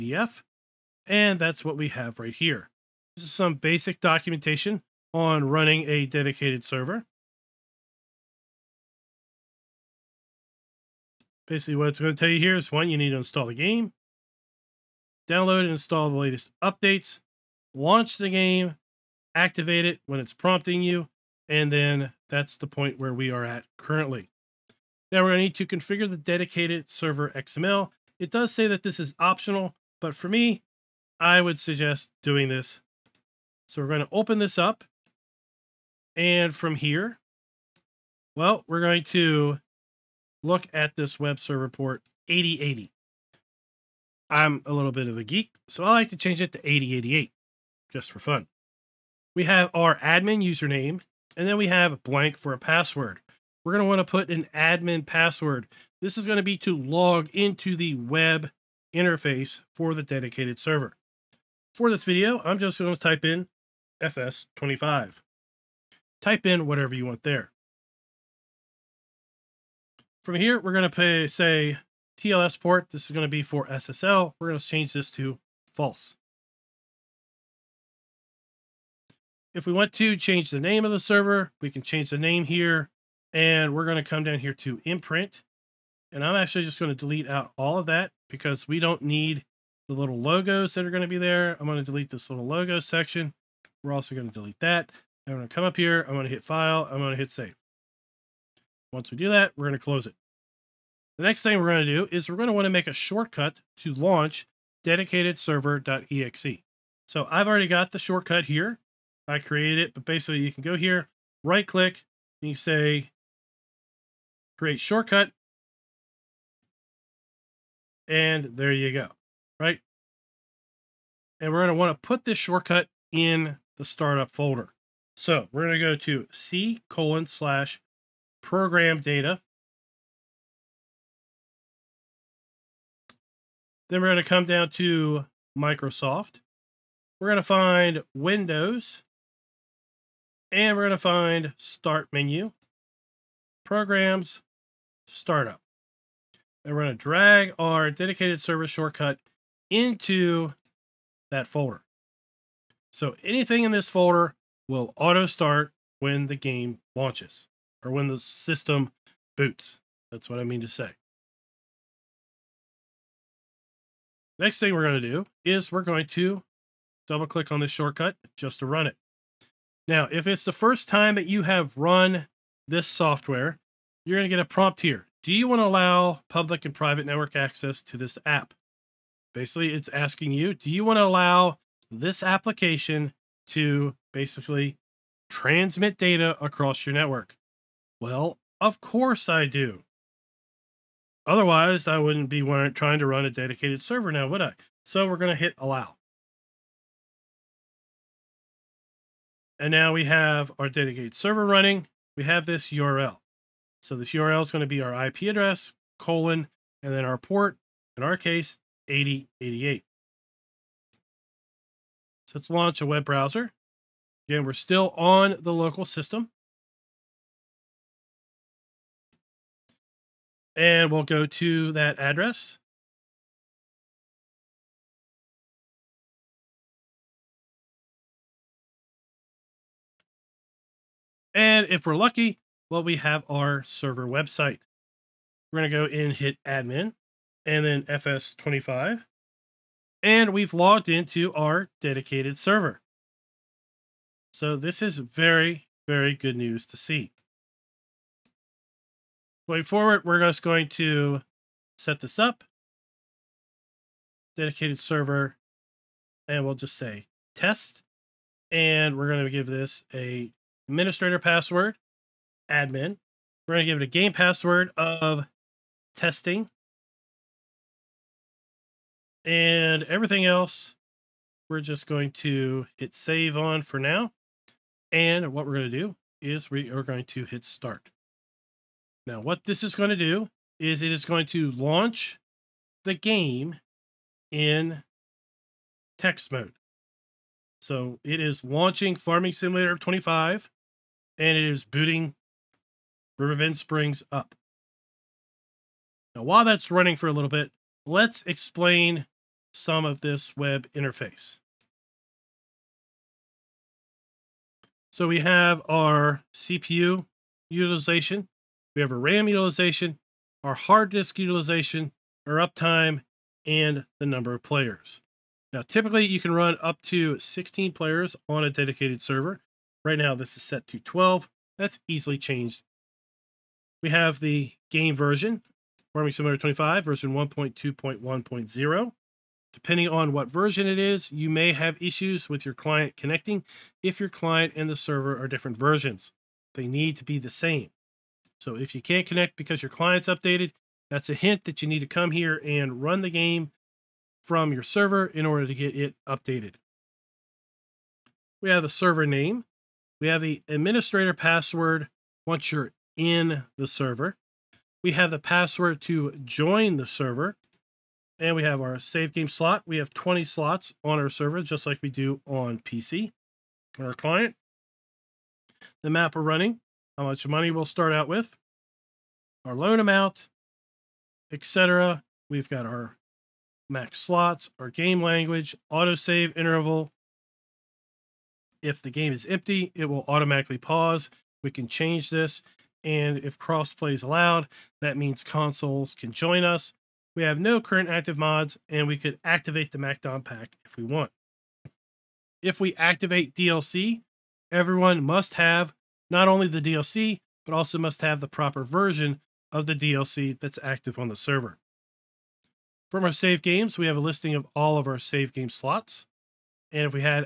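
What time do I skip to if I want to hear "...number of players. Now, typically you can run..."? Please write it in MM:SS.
05:14.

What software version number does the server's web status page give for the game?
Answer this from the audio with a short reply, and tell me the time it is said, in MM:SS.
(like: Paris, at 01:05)
1.2.1.0, at 05:27.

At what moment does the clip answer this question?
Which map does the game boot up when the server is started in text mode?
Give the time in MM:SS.
04:53.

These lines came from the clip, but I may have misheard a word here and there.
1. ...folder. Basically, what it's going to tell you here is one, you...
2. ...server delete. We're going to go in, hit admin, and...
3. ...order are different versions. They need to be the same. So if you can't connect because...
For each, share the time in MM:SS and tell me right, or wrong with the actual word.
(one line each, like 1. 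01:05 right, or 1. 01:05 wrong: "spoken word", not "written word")
1. 00:06 wrong: "server", not "folder"
2. 03:53 wrong: "website", not "delete"
3. 05:34 wrong: "server", not "order".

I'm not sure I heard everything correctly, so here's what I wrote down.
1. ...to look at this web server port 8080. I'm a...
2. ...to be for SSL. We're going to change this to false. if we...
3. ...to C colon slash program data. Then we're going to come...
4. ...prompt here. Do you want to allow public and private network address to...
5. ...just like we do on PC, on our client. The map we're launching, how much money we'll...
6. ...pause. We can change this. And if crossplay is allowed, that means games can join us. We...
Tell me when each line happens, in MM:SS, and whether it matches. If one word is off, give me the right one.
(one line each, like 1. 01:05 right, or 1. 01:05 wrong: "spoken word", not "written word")
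1. 00:39 right
2. 01:13 right
3. 02:05 right
4. 02:54 wrong: "access", not "address"
5. 06:01 wrong: "running", not "launching"
6. 06:20 wrong: "consoles", not "games".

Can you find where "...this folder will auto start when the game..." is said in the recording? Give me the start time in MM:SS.
02:33.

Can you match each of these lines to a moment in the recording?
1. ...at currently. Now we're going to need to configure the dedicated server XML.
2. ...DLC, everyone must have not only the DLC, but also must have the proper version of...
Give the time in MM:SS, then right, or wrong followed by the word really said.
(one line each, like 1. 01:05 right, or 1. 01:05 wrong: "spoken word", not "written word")
1. 00:23 right
2. 06:33 right.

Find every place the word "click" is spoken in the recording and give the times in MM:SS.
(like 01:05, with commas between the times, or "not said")
01:51, 02:47.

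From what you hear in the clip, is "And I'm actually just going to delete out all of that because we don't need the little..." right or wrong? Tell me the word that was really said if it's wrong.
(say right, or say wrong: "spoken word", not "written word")
right.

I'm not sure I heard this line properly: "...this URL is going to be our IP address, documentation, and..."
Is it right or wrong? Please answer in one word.
wrong.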